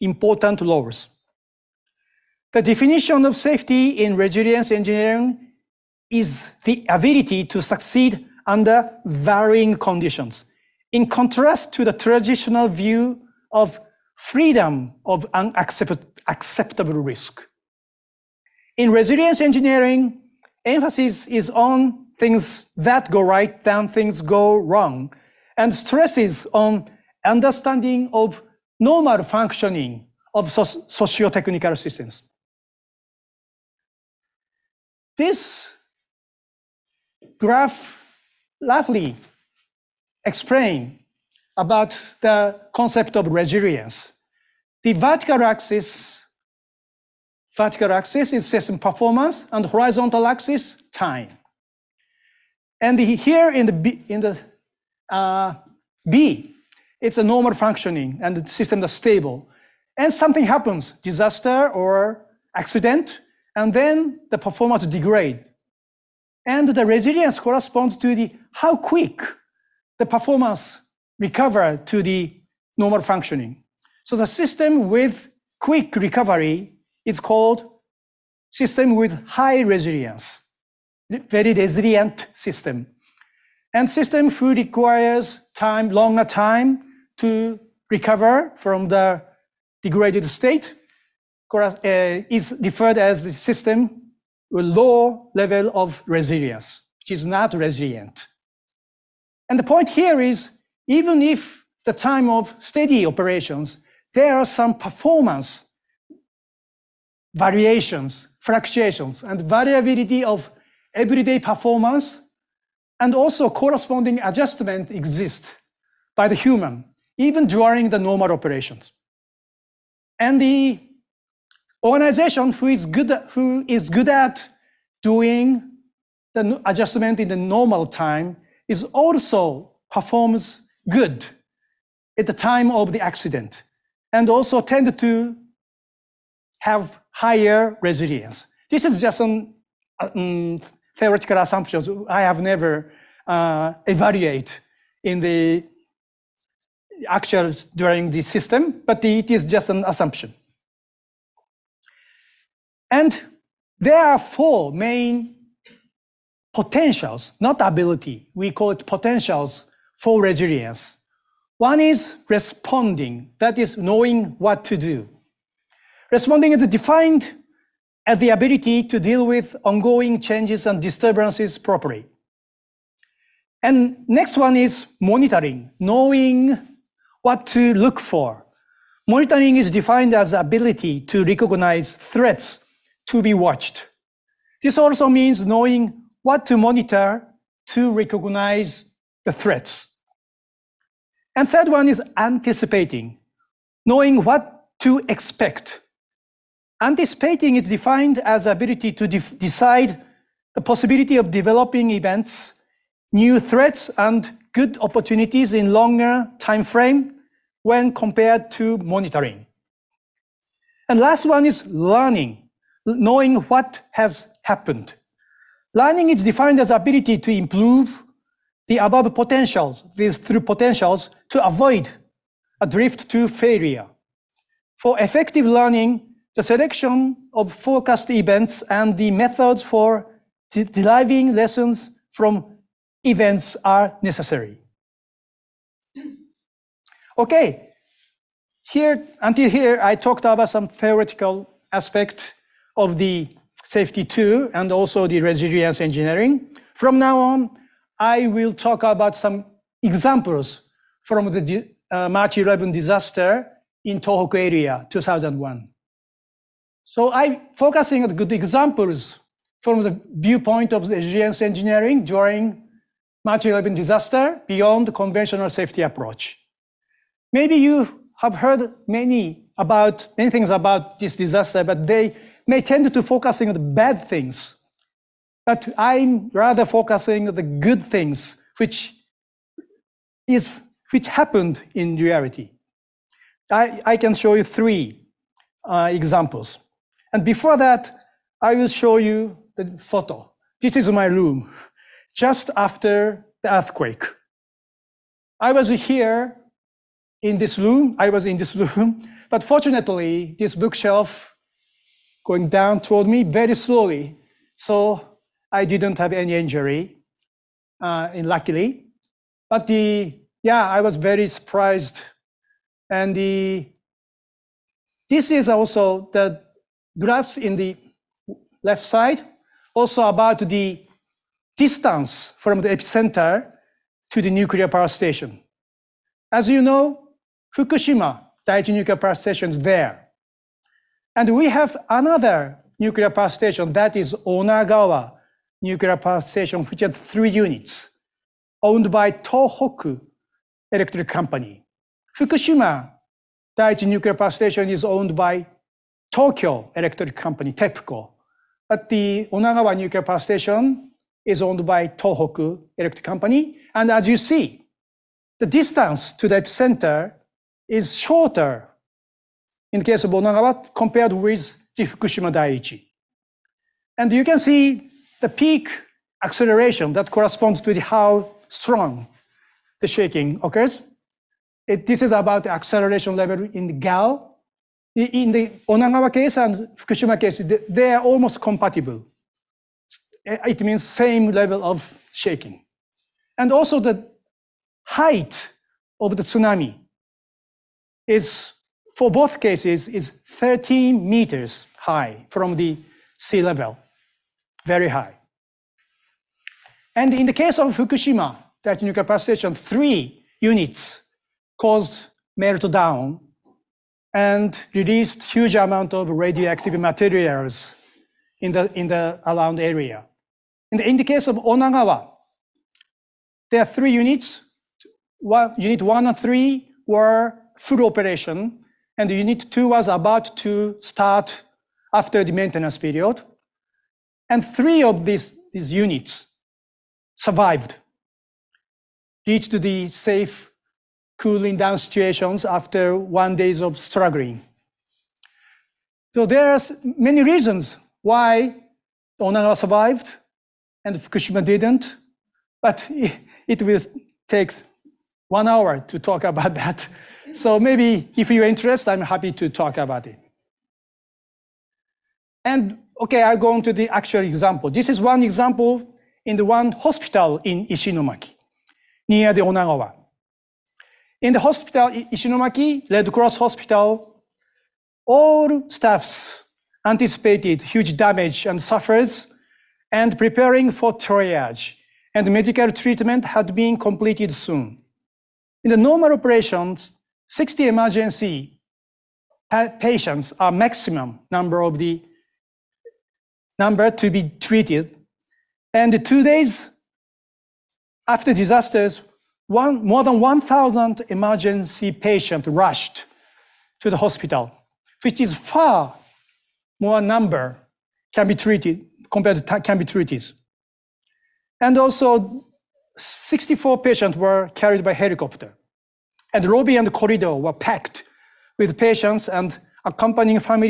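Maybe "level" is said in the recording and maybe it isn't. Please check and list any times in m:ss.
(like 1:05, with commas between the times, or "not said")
1:35, 6:13, 6:21, 6:33.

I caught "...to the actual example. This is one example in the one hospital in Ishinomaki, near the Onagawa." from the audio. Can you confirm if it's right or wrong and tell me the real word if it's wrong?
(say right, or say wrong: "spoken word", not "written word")
right.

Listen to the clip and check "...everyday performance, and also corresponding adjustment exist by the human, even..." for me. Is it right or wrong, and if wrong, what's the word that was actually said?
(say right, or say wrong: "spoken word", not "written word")
right.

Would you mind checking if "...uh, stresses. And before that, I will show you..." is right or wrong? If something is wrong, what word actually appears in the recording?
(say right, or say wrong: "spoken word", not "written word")
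wrong: "examples", not "stresses".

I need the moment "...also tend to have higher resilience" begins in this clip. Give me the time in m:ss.
2:14.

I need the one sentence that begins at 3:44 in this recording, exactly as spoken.
For effective learning, the selection of forecast events and the methods for de deriving lessons from events are necessary.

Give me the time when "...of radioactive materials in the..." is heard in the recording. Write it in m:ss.
6:45.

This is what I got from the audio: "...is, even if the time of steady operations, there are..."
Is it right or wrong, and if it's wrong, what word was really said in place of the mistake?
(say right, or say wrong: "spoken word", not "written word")
right.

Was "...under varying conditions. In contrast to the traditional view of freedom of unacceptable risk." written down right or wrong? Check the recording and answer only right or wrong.
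right.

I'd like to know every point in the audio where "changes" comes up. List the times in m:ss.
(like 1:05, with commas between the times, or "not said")
2:50.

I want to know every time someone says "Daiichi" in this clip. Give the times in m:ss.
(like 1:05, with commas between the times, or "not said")
5:28, 5:43, 6:02.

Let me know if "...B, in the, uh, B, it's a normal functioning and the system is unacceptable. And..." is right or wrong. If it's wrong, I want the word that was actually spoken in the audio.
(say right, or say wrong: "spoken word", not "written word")
wrong: "stable", not "unacceptable".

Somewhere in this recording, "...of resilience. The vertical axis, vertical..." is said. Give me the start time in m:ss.
0:43.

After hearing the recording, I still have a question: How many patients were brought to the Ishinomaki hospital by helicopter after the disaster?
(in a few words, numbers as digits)
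64.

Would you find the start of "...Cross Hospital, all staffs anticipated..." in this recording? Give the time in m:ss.
7:43.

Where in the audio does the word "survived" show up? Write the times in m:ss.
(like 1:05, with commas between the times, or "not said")
7:07, 7:19.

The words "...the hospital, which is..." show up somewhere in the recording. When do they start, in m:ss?
8:13.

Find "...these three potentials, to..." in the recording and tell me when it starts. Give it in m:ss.
3:39.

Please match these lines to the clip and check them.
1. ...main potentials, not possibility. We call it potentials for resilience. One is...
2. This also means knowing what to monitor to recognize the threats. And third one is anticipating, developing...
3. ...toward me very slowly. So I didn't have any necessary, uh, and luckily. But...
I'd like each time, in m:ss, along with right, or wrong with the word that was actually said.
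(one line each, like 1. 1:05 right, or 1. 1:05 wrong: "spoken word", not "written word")
1. 2:34 wrong: "ability", not "possibility"
2. 3:04 wrong: "knowing", not "developing"
3. 5:02 wrong: "injury", not "necessary".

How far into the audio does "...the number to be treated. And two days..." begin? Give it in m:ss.
8:01.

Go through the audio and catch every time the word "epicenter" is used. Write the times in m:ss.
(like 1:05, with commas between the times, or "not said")
5:22, 5:56.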